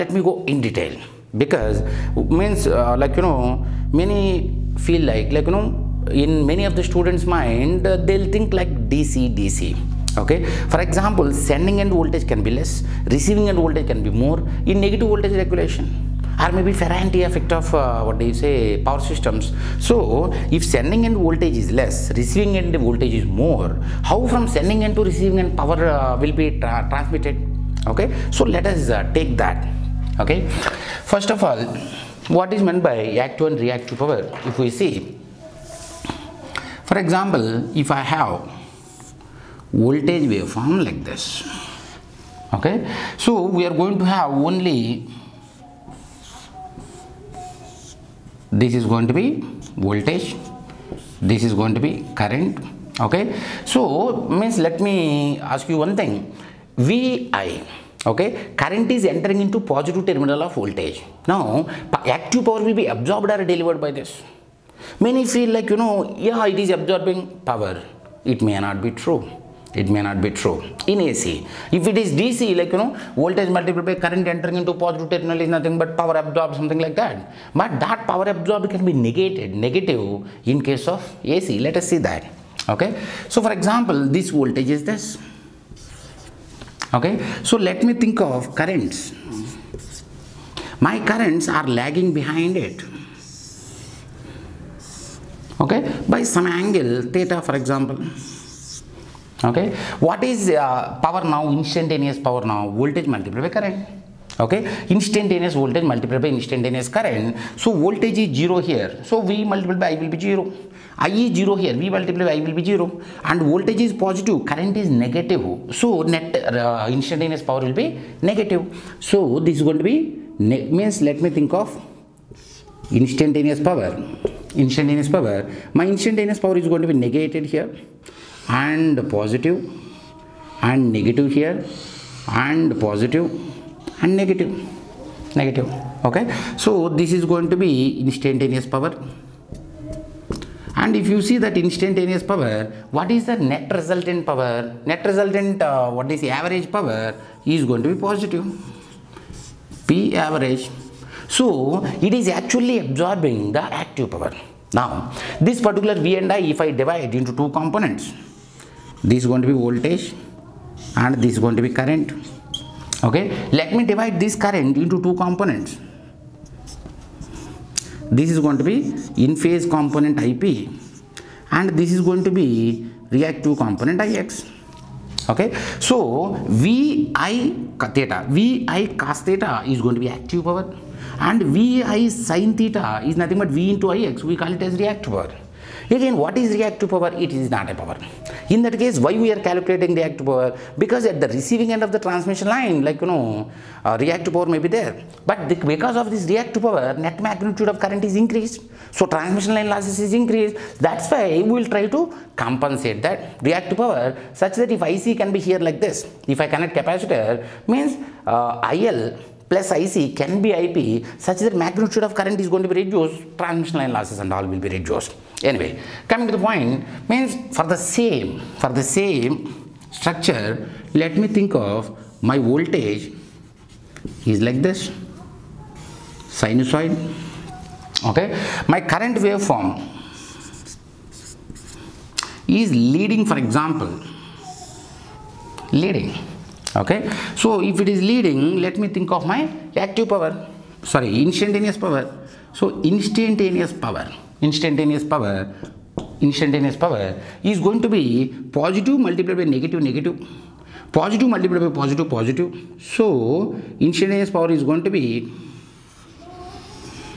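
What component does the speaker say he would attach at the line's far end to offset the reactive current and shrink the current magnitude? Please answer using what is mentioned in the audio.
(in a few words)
capacitor.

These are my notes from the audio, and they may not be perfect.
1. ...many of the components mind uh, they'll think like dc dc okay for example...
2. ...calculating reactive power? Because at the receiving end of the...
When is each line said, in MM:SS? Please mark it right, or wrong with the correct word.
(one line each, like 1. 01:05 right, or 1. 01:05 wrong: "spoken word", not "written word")
1. 00:06 wrong: "students", not "components"
2. 03:09 right.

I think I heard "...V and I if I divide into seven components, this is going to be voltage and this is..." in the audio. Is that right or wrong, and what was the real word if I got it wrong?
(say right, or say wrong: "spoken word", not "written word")
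wrong: "two", not "seven".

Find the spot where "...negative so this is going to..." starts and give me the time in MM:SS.
01:58.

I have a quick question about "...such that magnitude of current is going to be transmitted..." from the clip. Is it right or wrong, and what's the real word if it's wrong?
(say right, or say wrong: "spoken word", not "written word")
wrong: "reduced", not "transmitted".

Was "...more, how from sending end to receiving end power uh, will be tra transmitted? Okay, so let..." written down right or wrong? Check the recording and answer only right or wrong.
right.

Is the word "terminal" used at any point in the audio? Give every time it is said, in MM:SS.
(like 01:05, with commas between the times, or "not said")
01:00, 01:15.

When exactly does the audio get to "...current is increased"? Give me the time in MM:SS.
03:17.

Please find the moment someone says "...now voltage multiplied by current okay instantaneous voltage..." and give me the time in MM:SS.
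01:42.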